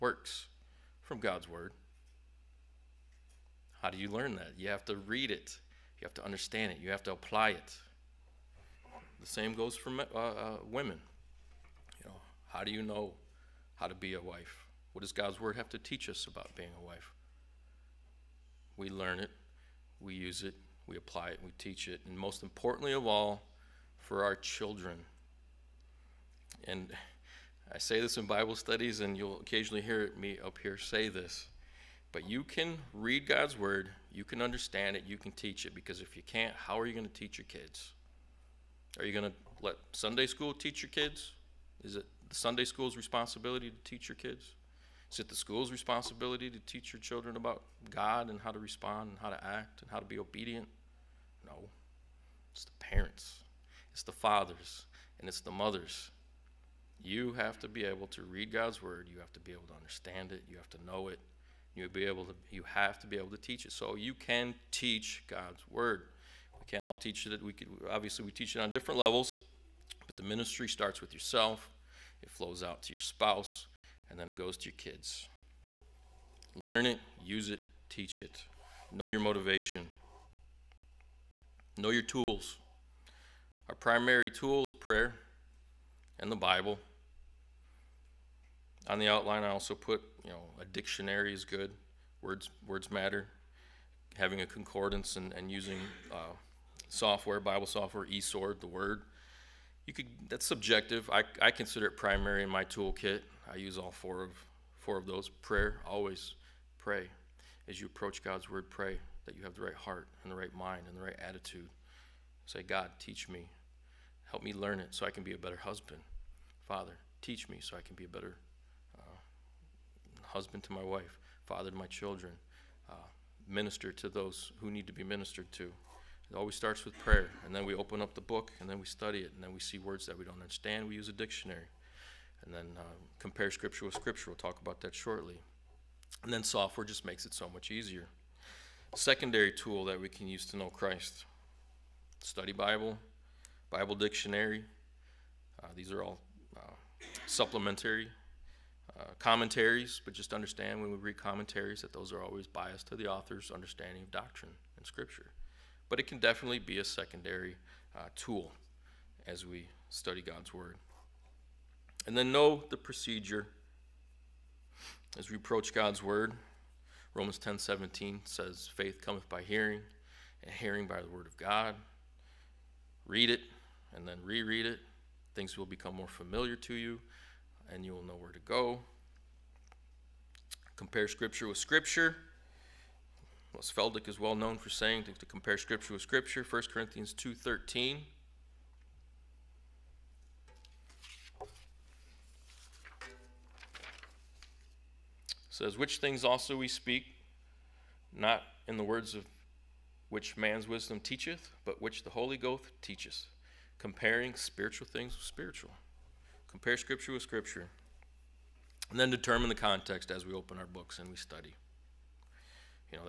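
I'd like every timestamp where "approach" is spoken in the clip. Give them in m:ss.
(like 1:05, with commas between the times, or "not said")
1:47, 2:45.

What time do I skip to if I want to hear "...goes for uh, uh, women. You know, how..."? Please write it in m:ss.
0:09.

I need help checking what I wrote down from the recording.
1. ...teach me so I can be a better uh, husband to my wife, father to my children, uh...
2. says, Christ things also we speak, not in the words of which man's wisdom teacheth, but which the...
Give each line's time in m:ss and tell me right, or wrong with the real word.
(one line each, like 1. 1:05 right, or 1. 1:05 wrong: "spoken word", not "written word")
1. 1:57 right
2. 3:15 wrong: "Which", not "Christ".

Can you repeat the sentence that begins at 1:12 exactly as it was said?
It flows out to your spouse and then it goes to your kids.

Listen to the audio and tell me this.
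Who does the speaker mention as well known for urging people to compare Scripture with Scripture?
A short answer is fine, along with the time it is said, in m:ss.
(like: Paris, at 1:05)
Feldick, at 3:03.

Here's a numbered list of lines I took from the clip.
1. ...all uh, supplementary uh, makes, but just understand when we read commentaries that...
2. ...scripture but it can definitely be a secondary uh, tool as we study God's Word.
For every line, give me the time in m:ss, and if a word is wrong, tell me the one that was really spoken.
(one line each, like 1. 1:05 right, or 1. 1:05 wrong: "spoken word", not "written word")
1. 2:26 wrong: "commentaries", not "makes"
2. 2:34 right.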